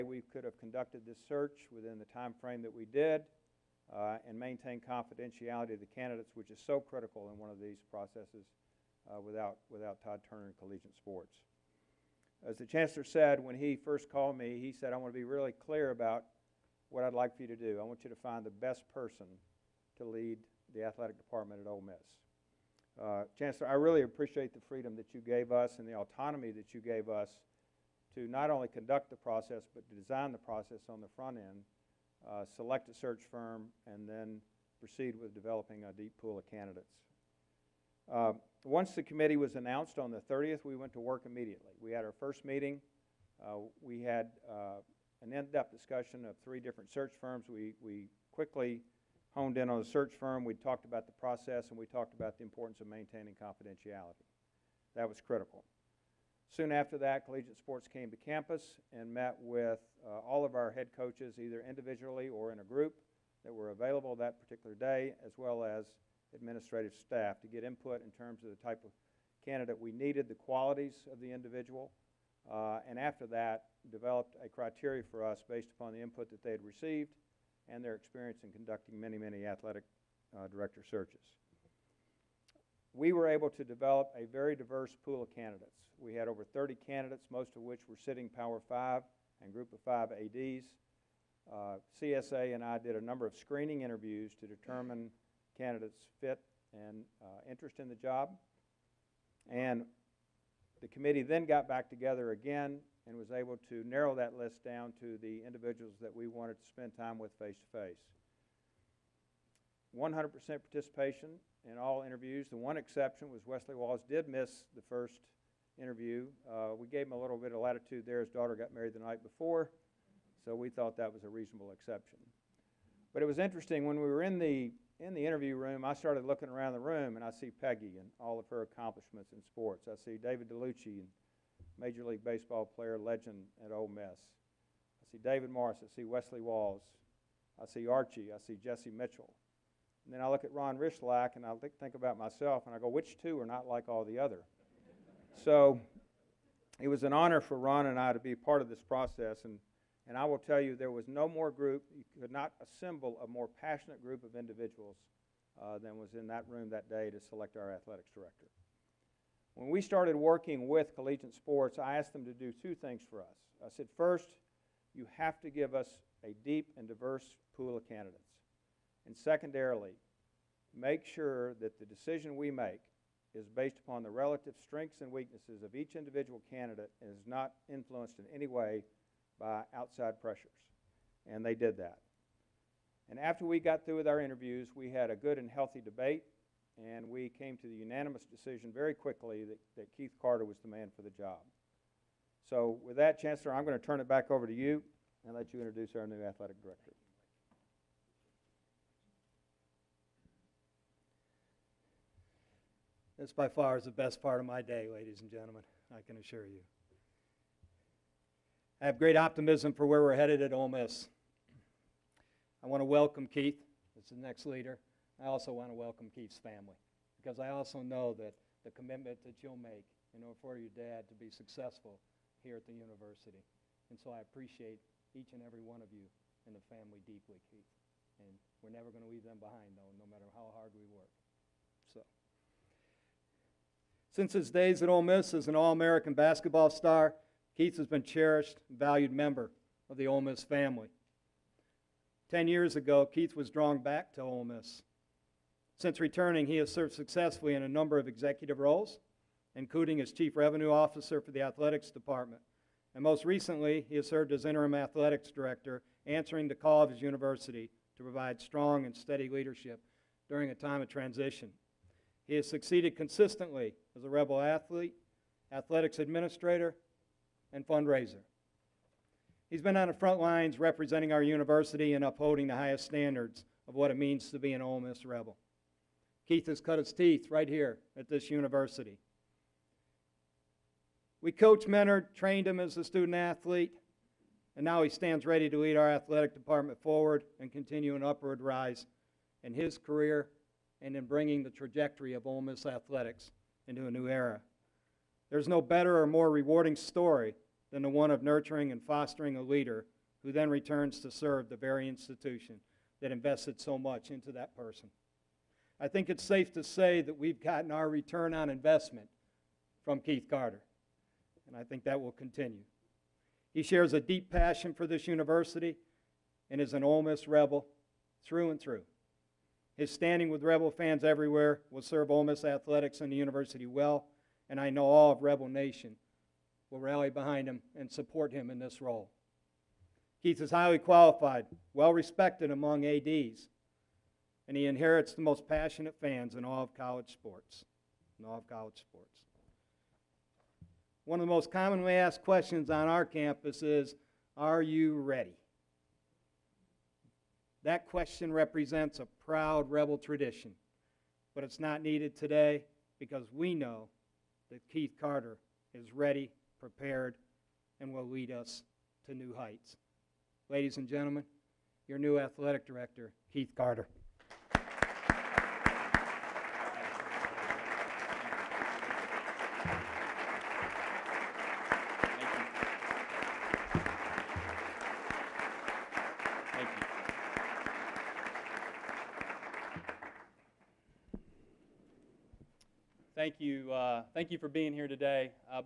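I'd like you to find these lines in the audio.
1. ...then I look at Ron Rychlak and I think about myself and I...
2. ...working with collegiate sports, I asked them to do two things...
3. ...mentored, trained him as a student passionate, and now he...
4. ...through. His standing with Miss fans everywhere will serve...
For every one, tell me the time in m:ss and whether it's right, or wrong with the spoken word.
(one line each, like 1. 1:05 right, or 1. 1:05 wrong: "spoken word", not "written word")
1. 2:20 right
2. 2:40 right
3. 4:41 wrong: "athlete", not "passionate"
4. 5:18 wrong: "Rebel", not "Miss".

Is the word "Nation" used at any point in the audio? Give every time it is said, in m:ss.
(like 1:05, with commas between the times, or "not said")
5:25.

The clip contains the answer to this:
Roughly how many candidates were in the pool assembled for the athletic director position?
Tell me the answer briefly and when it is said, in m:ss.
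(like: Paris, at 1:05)
Over 30, at 1:26.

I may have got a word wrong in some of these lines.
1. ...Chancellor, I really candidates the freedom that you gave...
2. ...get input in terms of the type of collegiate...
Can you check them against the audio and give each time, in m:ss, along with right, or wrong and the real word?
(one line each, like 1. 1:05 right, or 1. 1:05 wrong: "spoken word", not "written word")
1. 0:23 wrong: "appreciate", not "candidates"
2. 1:07 wrong: "candidate", not "collegiate".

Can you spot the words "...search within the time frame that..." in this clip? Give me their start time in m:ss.
0:01.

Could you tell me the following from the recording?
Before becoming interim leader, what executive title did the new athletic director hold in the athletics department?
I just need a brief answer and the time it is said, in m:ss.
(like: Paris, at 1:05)
Chief Revenue Officer, at 4:10.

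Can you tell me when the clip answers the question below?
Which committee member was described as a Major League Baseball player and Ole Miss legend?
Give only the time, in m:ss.
2:10.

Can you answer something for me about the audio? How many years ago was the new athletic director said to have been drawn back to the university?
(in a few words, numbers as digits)
10.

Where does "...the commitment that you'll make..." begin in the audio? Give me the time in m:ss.
3:38.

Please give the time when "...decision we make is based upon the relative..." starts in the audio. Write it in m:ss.
2:51.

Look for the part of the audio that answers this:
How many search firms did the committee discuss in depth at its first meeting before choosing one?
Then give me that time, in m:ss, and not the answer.
0:46.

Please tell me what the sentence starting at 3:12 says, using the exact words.
So, with that, Chancellor, I'm going to turn it back over to you and let you introduce our new athletic director.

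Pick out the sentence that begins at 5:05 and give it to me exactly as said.
I think it's safe to say that we've gotten our return on investment from Keith Carter, and I think that will continue.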